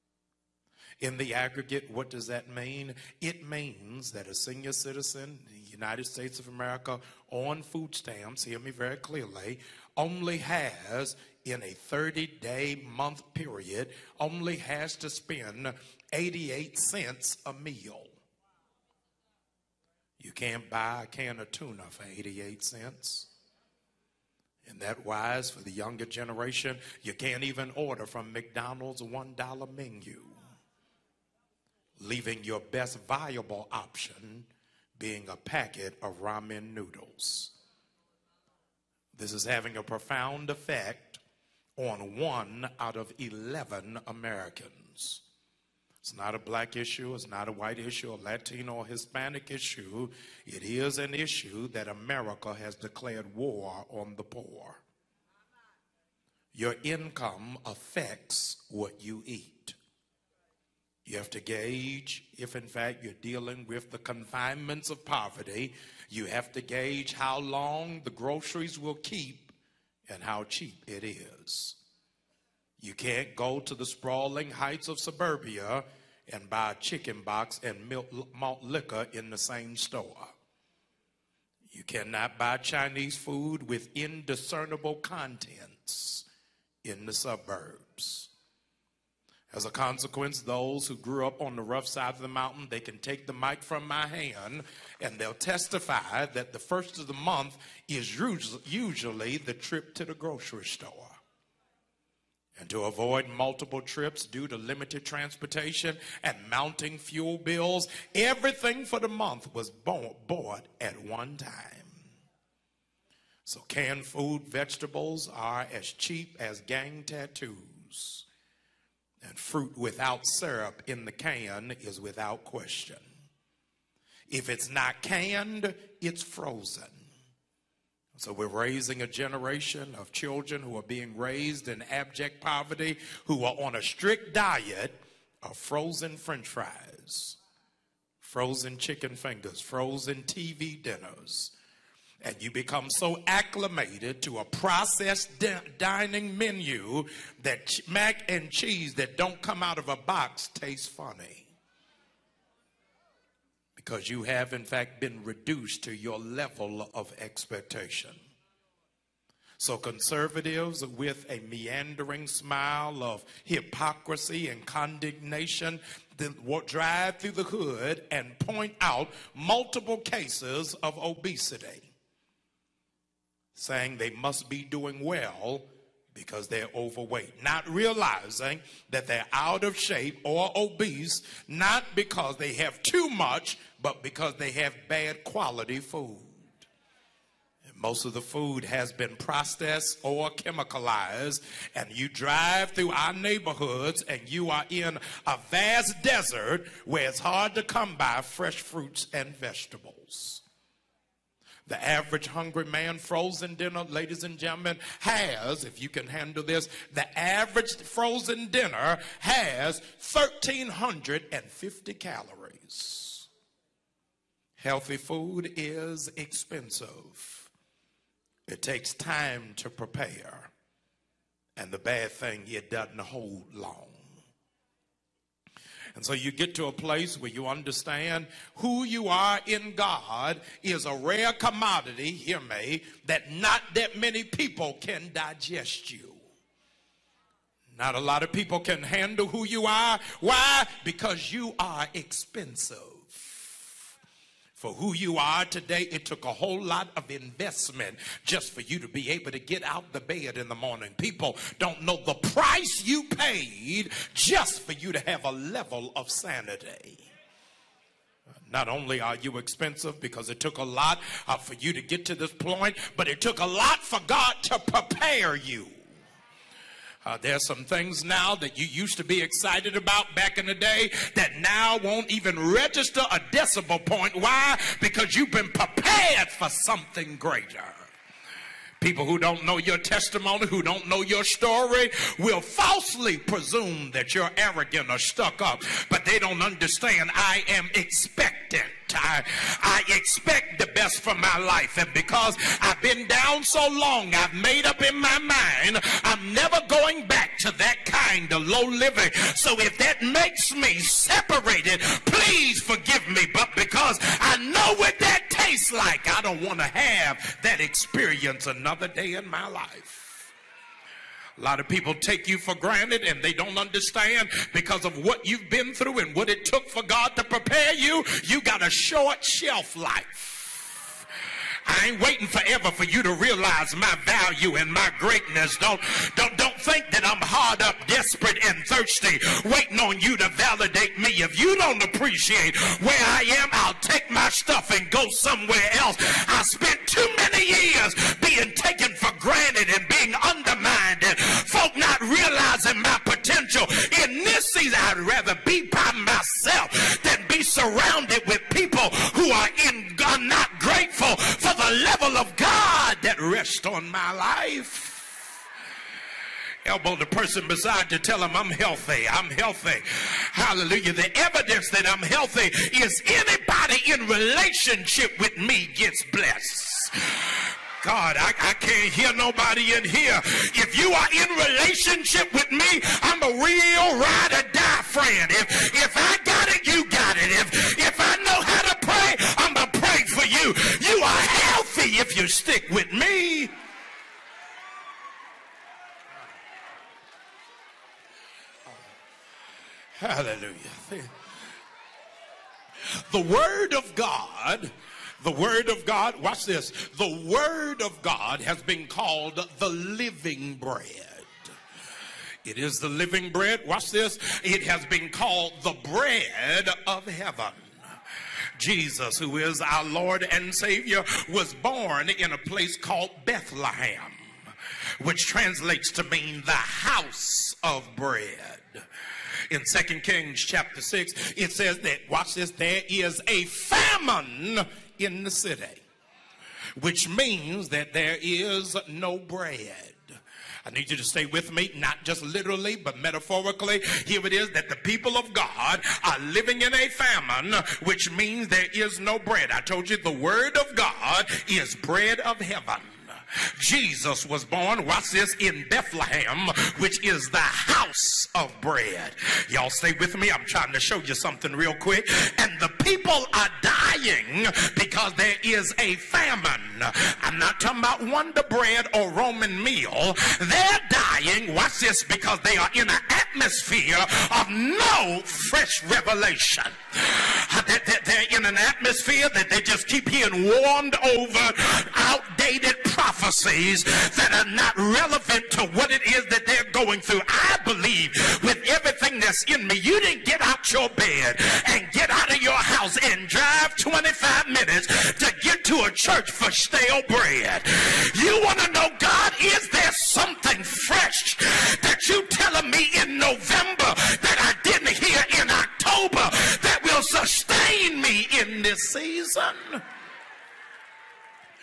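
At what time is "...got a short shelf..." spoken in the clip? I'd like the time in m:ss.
5:18.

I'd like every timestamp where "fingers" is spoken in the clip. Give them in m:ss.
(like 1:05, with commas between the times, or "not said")
2:19.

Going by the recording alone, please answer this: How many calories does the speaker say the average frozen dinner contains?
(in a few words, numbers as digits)
1,350.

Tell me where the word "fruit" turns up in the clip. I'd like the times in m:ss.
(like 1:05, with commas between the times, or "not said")
1:59, 3:18.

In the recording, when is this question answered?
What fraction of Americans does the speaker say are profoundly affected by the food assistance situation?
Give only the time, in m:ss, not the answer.
0:42.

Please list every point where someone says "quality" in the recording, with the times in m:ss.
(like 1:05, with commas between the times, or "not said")
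3:05.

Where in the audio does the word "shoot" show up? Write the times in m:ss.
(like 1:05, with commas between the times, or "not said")
not said.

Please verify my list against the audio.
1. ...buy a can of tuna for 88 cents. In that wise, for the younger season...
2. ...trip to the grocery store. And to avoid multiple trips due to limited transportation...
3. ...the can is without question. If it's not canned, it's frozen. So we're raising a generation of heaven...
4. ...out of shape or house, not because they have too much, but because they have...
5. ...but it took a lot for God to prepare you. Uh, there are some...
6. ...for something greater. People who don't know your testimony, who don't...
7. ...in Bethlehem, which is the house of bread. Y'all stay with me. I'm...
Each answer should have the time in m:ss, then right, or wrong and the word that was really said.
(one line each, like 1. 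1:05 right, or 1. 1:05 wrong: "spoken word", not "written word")
1. 0:20 wrong: "generation", not "season"
2. 1:39 right
3. 2:01 wrong: "children", not "heaven"
4. 2:59 wrong: "obese", not "house"
5. 4:22 right
6. 4:36 right
7. 7:25 right.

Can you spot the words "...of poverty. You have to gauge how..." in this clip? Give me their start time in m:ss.
1:04.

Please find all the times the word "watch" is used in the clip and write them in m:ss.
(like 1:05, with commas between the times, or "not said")
6:36, 6:43, 7:02, 7:24, 7:41.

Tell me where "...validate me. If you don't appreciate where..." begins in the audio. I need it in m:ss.
5:30.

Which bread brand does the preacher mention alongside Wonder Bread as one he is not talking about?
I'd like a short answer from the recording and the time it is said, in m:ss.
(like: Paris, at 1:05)
Roman Meal, at 7:39.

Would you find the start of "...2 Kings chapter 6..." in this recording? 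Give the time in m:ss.
6:59.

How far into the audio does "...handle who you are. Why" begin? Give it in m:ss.
3:58.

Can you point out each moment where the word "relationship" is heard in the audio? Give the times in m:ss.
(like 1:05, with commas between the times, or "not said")
6:04, 6:11.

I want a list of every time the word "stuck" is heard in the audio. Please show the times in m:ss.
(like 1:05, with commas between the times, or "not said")
4:44.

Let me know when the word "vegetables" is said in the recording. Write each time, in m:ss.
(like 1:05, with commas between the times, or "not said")
1:54, 3:19.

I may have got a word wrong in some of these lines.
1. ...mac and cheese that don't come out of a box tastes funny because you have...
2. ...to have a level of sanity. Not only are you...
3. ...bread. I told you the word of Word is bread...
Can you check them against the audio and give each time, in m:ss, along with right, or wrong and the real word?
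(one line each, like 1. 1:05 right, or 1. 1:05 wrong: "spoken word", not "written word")
1. 2:27 right
2. 4:14 right
3. 7:19 wrong: "God", not "Word".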